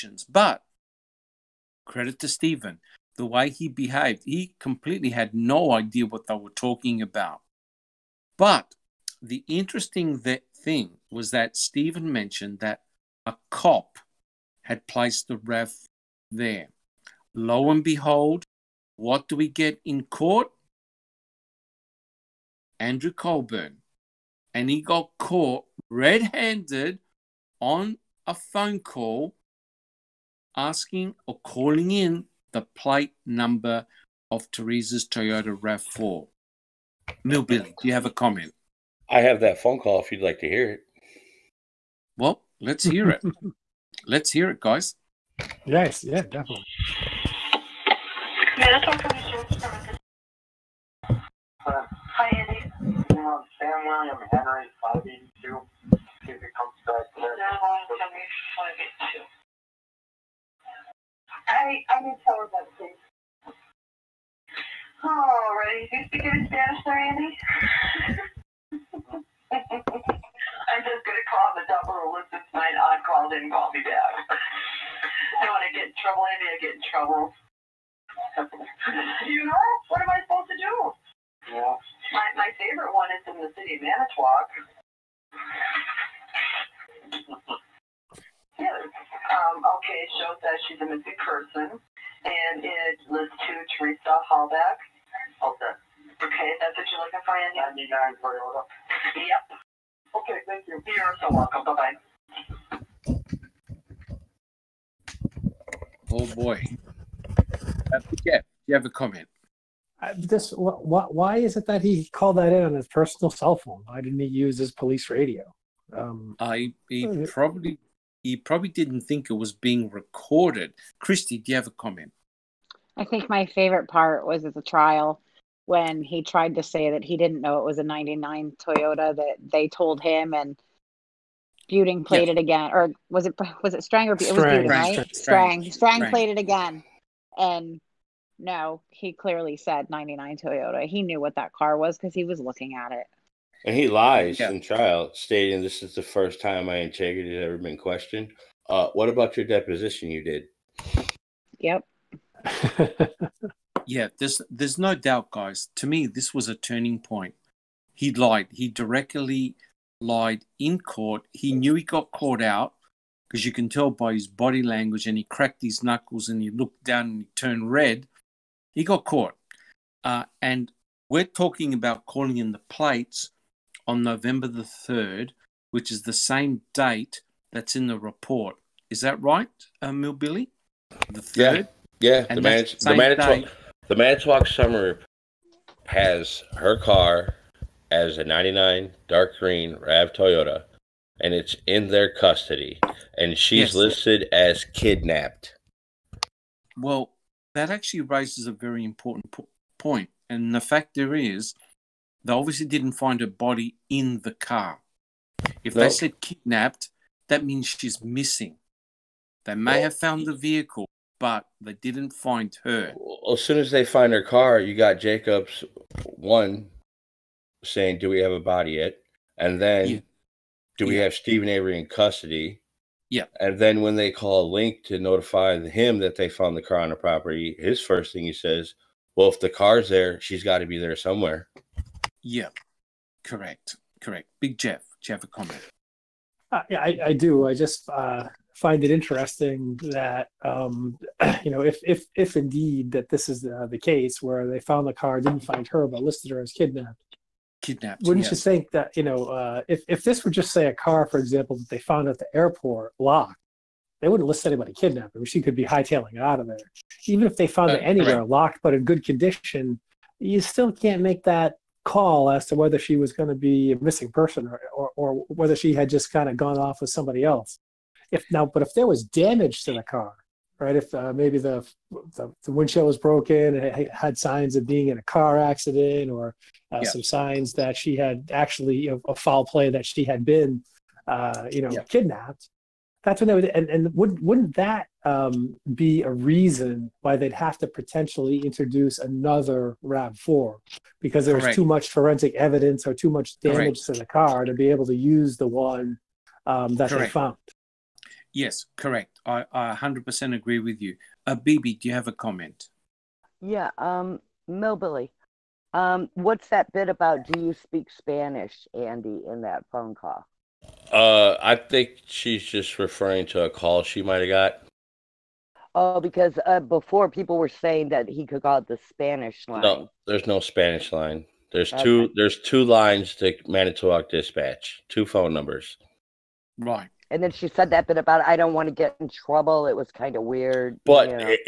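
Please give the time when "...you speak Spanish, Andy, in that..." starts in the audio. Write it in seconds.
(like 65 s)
307 s.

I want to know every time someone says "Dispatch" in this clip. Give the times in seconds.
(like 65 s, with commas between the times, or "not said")
324 s.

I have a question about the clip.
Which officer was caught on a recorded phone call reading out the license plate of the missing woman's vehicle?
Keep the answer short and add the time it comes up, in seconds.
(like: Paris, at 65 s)
Andrew Colburn, at 22 s.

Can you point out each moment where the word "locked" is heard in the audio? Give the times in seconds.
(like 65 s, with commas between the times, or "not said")
252 s, 258 s.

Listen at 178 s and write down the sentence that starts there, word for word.
Is that right, uh, Mill Billy?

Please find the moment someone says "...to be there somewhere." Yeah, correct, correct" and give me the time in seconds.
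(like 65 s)
230 s.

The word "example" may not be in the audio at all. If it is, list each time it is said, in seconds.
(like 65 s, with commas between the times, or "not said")
251 s.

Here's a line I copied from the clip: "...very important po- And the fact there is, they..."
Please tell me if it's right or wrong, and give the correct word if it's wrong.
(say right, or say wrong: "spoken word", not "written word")
right.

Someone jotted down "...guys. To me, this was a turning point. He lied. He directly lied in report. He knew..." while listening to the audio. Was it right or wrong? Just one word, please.
wrong.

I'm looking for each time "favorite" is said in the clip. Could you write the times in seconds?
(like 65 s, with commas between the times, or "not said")
82 s, 123 s.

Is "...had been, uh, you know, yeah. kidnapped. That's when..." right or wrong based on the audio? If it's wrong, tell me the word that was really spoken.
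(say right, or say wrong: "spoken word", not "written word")
right.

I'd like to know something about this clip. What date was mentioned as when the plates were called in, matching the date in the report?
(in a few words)
November 3.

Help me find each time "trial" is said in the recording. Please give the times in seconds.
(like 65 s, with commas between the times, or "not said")
124 s, 144 s.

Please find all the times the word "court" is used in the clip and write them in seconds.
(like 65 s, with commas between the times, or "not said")
20 s, 160 s.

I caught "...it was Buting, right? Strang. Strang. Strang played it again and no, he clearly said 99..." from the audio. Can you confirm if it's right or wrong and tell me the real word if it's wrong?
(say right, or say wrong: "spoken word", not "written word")
right.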